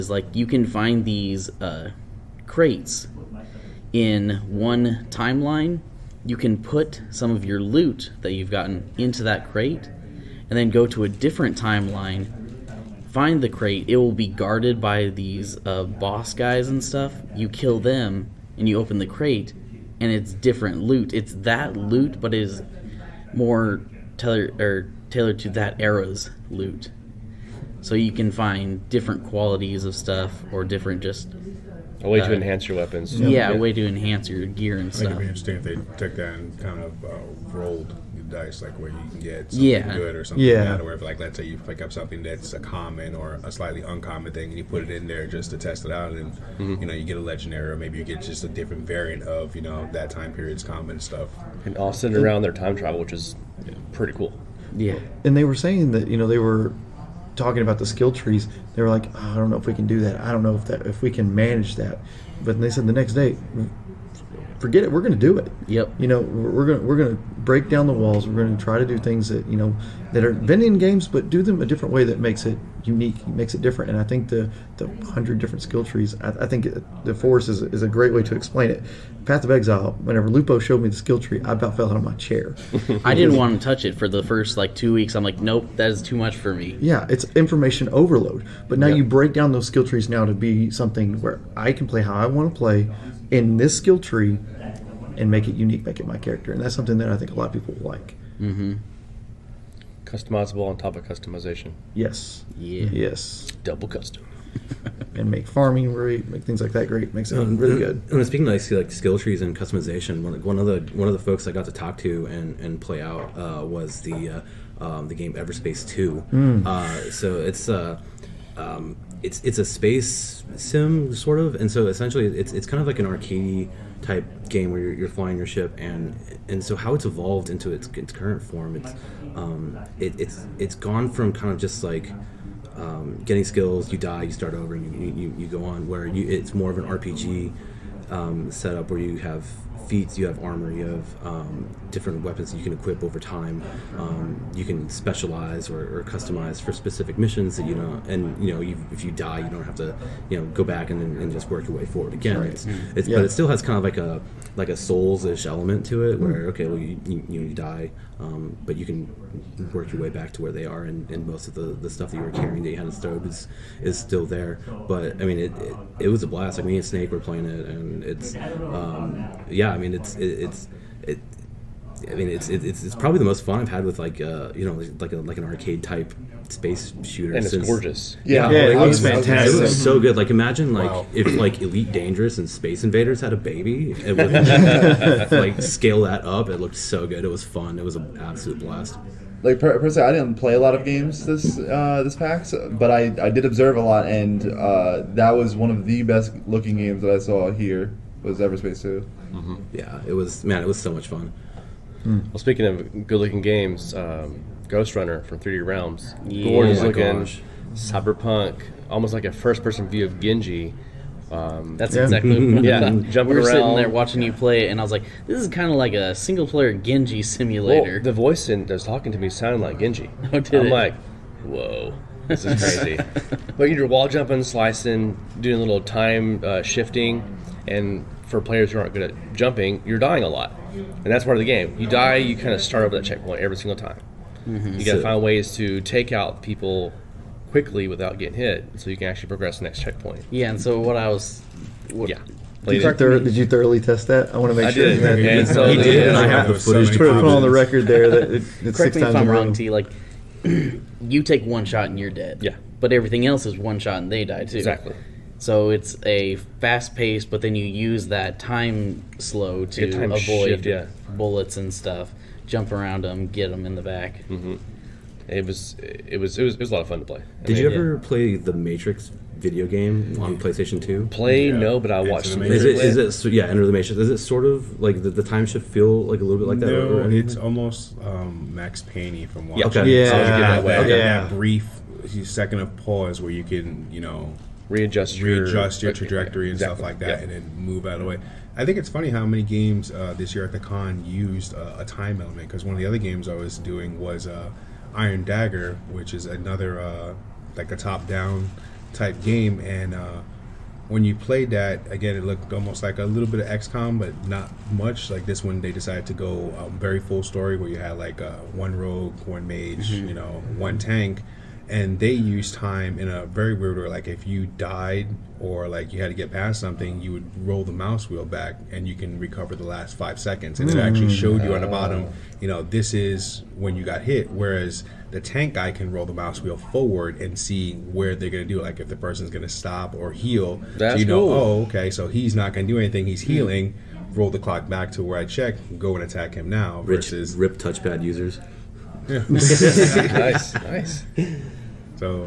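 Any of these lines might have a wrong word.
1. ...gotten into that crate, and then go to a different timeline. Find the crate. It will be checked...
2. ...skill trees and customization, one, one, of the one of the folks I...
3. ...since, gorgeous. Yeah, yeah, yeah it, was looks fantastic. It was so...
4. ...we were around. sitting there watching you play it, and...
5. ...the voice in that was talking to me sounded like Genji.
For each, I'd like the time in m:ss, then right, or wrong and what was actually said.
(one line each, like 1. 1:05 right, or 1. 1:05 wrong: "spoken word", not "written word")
1. 0:08 wrong: "guarded", not "checked"
2. 1:48 right
3. 2:57 right
4. 3:33 right
5. 3:38 right.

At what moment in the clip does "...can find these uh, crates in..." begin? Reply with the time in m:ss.
0:00.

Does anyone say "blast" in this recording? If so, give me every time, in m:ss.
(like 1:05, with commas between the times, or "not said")
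2:46, 3:08.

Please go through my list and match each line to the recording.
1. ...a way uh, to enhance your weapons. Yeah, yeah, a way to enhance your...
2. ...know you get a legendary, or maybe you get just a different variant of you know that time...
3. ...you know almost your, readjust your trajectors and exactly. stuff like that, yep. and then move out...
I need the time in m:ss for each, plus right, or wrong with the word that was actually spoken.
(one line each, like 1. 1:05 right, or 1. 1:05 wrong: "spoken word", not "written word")
1. 0:32 right
2. 0:46 right
3. 4:43 wrong: "readjust", not "almost".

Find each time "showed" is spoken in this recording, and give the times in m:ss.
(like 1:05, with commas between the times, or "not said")
1:20, 5:21.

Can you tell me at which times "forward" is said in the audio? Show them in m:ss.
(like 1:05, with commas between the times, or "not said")
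2:31, 5:26.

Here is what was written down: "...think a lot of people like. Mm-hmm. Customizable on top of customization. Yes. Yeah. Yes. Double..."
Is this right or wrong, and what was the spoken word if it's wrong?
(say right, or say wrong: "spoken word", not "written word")
right.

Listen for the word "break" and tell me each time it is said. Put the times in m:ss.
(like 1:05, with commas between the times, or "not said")
1:07, 1:29.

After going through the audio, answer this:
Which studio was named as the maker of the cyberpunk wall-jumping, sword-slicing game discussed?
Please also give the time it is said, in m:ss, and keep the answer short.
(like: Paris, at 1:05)
3D Realms, at 3:25.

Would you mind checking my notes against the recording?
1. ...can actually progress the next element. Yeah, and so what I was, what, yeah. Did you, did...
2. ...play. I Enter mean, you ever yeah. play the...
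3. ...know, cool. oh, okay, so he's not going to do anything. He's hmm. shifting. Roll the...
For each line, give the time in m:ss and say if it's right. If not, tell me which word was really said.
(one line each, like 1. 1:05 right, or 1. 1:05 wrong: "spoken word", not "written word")
1. 3:58 wrong: "checkpoint", not "element"
2. 4:27 wrong: "Did", not "Enter"
3. 5:31 wrong: "healing", not "shifting".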